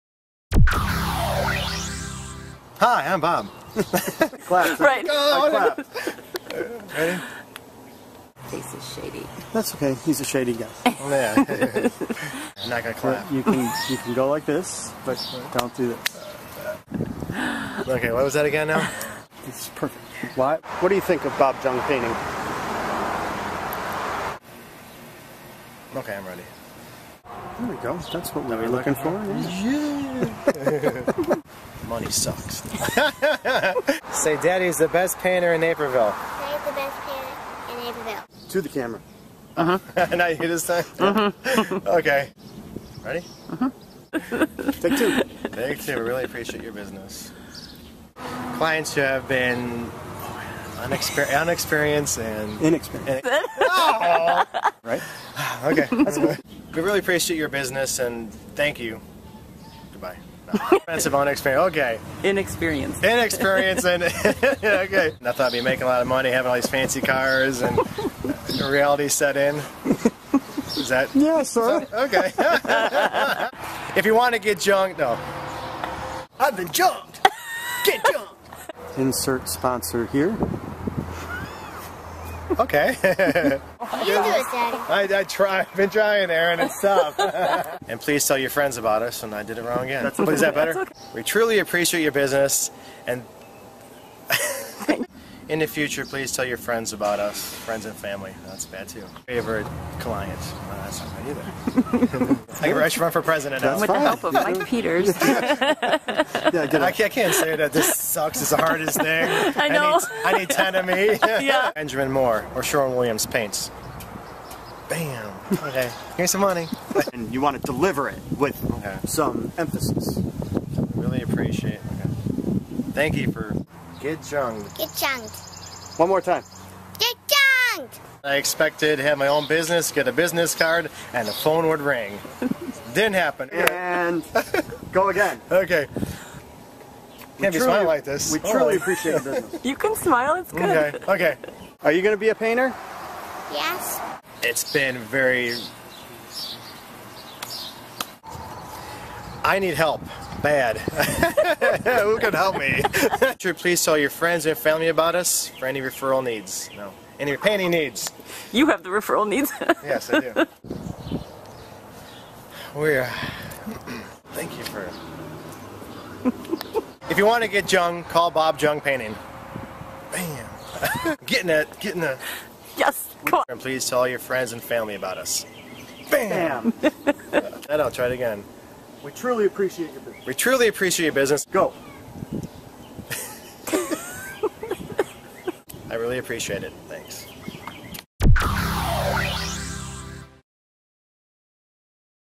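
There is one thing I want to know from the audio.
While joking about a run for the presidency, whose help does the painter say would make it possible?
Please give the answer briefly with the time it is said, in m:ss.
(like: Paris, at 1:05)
Mike Peters, at 1:44.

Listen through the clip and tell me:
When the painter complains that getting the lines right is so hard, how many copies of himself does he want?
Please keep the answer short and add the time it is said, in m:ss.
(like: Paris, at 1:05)
10, at 1:50.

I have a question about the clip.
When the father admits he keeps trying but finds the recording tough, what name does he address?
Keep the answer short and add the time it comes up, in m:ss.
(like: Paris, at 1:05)
Aaron, at 1:26.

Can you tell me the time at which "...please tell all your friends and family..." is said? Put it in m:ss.
2:53.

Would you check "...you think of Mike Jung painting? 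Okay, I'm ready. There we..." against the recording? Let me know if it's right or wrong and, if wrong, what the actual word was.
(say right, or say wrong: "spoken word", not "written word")
wrong: "Bob", not "Mike".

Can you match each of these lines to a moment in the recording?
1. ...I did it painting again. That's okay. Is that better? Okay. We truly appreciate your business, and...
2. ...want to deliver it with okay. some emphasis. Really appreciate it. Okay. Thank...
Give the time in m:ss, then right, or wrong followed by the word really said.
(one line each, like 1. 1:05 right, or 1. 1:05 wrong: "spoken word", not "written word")
1. 1:29 wrong: "wrong", not "painting"
2. 1:57 right.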